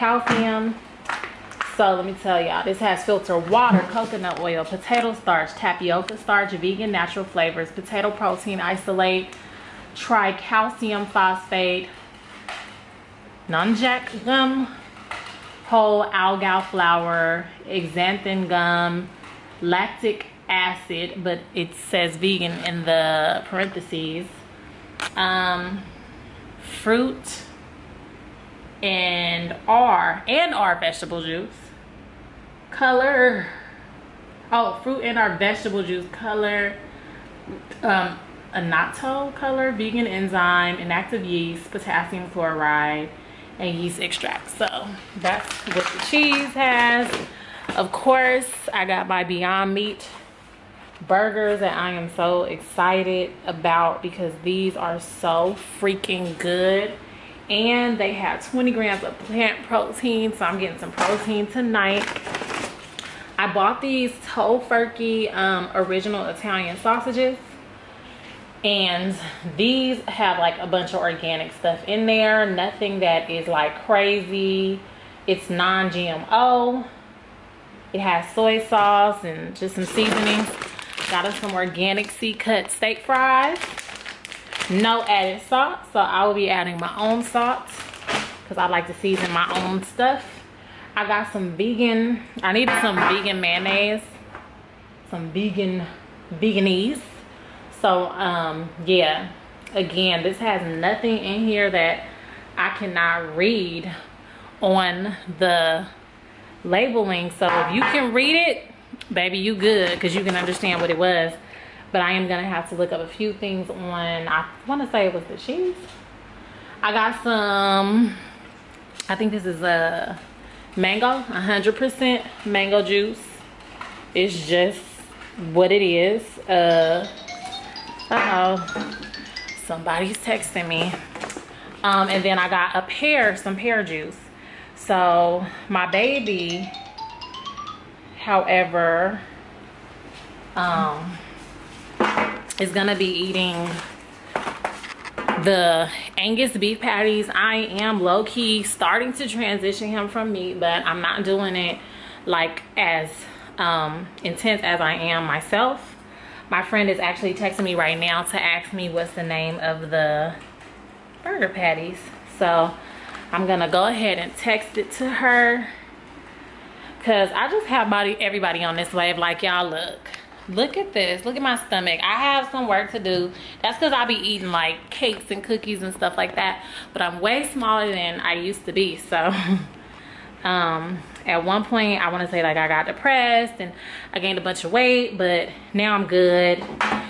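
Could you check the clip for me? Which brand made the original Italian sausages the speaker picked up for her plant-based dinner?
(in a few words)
Tofurky.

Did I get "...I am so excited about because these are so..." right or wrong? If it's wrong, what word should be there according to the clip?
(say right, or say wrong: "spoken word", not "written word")
right.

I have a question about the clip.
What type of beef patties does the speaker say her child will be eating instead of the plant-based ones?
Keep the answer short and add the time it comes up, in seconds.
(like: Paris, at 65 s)
Angus, at 146 s.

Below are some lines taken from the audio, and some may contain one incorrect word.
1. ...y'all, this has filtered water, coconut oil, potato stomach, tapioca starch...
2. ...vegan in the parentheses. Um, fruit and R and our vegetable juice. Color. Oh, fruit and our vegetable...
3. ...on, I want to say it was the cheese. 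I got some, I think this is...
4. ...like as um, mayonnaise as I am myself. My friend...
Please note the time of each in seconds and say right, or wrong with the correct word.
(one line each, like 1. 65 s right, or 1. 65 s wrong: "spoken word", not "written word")
1. 2 s wrong: "starch", not "stomach"
2. 22 s right
3. 113 s right
4. 152 s wrong: "intense", not "mayonnaise".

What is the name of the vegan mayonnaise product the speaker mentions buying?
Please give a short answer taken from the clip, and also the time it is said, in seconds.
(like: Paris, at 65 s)
Vegenaise, at 96 s.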